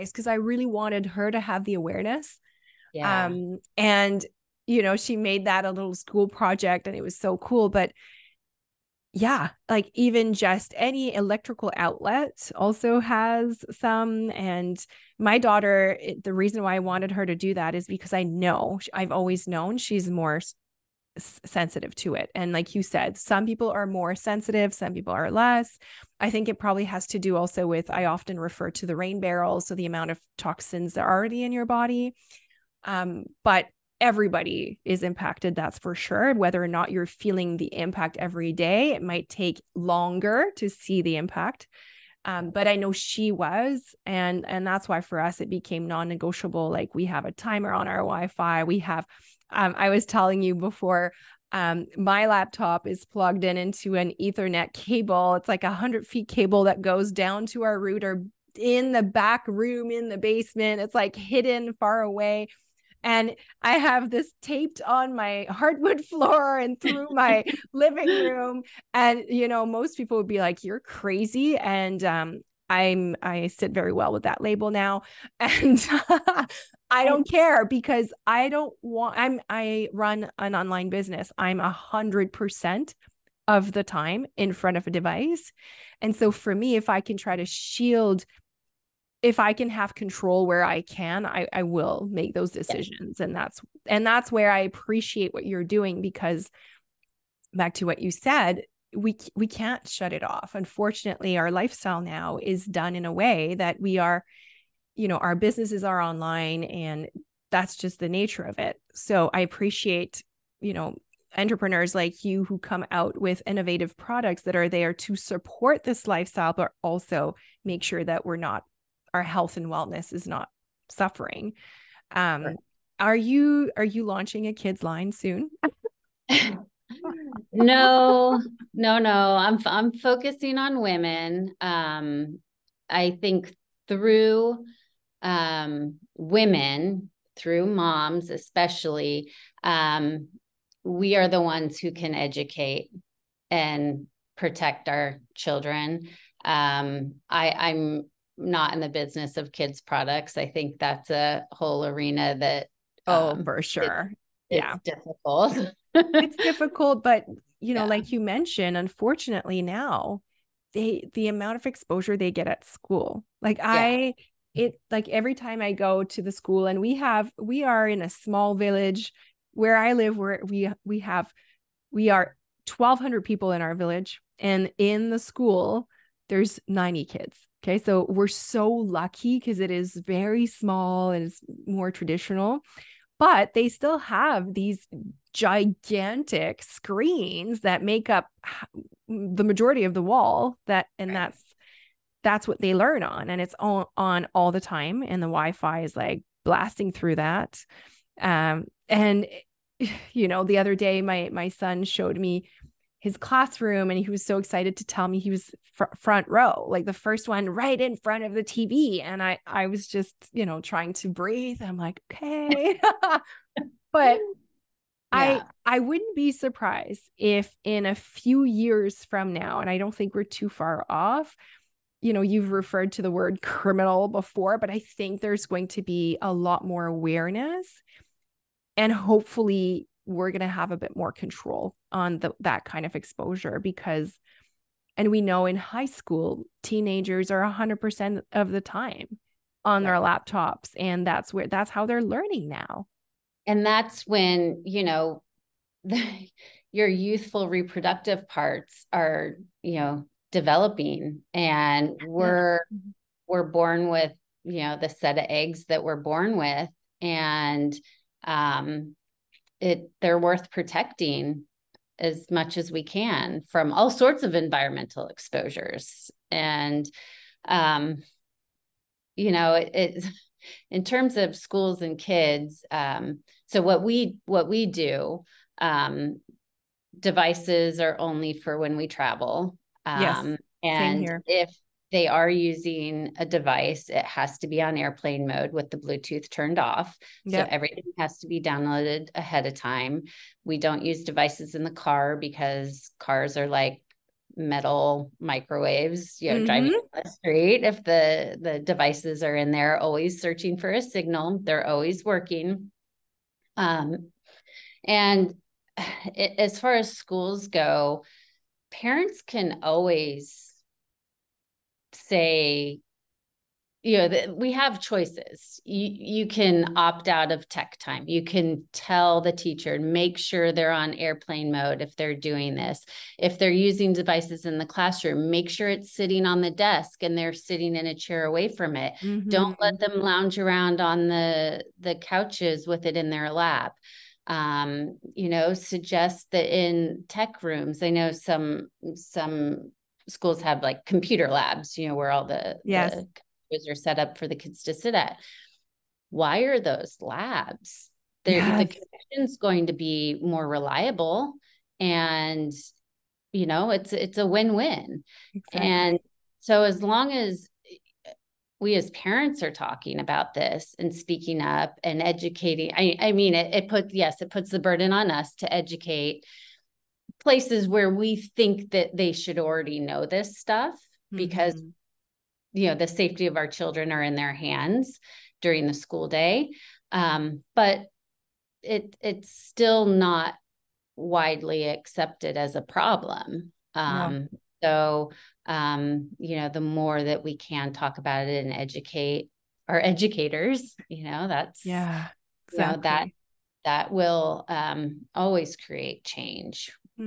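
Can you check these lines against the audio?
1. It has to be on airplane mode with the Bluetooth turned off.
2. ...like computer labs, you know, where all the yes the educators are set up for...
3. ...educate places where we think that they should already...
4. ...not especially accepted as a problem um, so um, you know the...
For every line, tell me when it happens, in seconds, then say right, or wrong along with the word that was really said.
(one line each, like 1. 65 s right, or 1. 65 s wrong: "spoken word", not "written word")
1. 283 s right
2. 340 s wrong: "computers", not "educators"
3. 365 s right
4. 379 s wrong: "widely", not "especially".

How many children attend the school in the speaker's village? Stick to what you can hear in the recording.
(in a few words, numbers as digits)
90.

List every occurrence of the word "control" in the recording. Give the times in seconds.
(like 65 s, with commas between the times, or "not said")
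89 s, 231 s.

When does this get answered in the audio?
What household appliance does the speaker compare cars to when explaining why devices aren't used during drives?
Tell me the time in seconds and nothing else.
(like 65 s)
294 s.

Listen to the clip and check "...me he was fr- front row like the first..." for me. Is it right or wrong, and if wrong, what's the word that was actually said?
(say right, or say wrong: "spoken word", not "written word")
right.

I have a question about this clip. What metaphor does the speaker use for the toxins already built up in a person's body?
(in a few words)
the rain barrel.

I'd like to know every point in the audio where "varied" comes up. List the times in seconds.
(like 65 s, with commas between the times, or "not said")
not said.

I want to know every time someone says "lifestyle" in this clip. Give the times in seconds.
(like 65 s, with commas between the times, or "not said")
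101 s, 116 s.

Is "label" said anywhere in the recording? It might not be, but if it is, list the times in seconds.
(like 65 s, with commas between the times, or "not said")
74 s.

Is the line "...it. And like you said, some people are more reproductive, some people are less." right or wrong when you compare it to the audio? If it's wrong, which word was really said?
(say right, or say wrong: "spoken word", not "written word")
wrong: "sensitive", not "reproductive".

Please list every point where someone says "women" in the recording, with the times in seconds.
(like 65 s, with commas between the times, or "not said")
130 s, 136 s.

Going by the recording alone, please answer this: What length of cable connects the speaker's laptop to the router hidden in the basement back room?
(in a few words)
100 feet.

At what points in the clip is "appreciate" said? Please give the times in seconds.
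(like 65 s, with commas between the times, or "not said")
94 s, 109 s.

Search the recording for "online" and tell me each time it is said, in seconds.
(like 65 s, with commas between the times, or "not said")
80 s, 106 s.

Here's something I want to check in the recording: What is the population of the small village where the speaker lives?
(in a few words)
1200 people.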